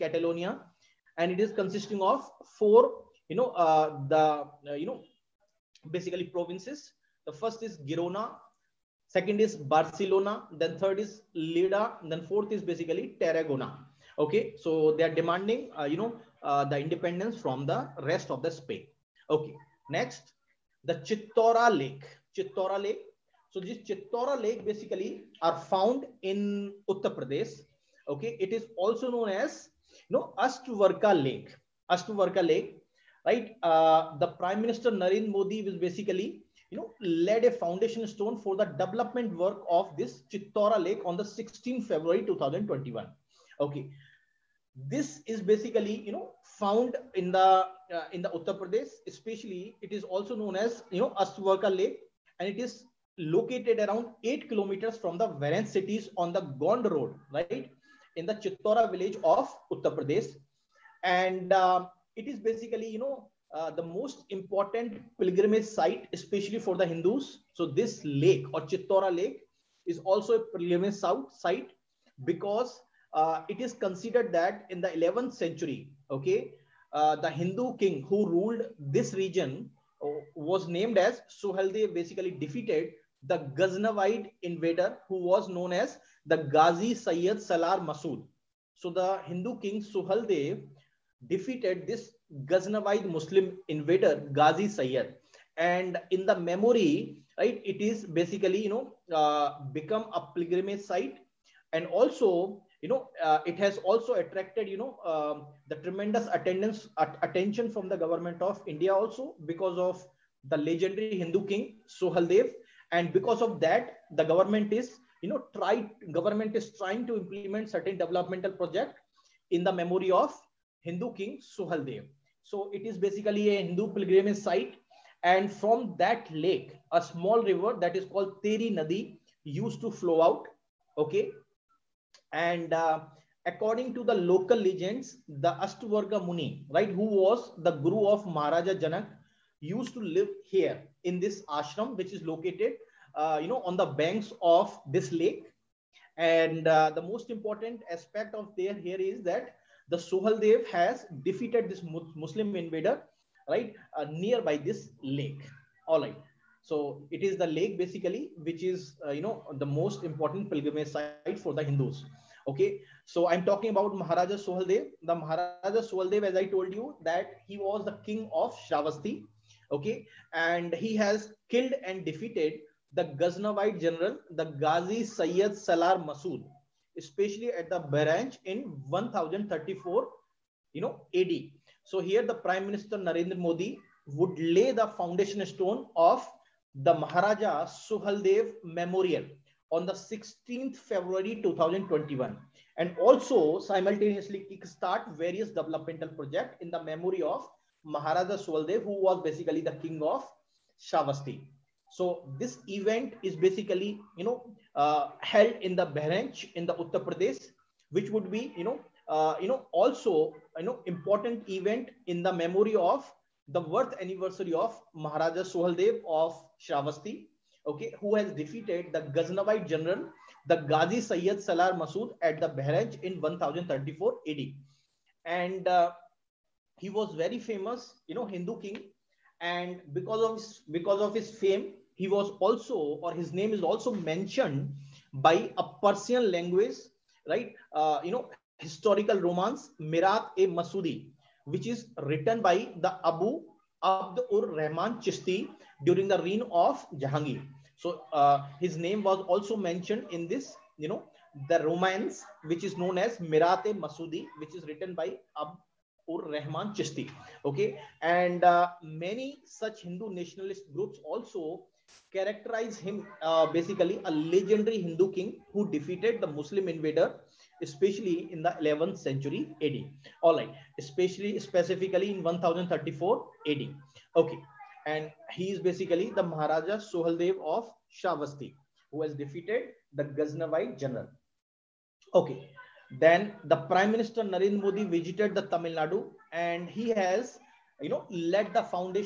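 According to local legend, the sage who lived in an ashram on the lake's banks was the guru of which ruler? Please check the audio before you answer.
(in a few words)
Maharaja Janak.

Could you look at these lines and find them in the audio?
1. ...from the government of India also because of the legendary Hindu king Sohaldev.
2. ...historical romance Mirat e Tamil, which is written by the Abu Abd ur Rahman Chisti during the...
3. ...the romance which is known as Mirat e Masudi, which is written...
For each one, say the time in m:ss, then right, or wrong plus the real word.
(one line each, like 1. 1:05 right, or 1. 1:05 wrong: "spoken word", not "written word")
1. 1:47 right
2. 3:58 wrong: "Masudi", not "Tamil"
3. 4:11 right.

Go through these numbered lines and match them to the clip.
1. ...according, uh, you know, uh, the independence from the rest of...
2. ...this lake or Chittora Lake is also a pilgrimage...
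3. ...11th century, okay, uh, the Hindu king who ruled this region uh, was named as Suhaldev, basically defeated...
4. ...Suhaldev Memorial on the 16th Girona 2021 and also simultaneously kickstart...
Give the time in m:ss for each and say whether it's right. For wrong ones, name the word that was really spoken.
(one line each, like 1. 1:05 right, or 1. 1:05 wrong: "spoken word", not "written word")
1. 0:15 wrong: "demanding", not "according"
2. 1:07 right
3. 1:14 right
4. 3:07 wrong: "February", not "Girona".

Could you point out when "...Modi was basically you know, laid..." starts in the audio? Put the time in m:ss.
0:35.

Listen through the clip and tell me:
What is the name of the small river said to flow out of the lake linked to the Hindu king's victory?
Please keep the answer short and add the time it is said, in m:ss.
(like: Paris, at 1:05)
Teri Nadi, at 2:08.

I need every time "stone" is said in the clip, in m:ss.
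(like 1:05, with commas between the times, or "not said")
0:38, 3:05.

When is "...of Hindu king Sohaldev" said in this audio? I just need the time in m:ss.
2:00.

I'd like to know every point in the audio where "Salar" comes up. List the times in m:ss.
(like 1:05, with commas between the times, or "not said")
1:27, 2:55, 3:41.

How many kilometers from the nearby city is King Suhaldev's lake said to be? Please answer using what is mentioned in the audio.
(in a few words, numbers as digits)
8 kilometers.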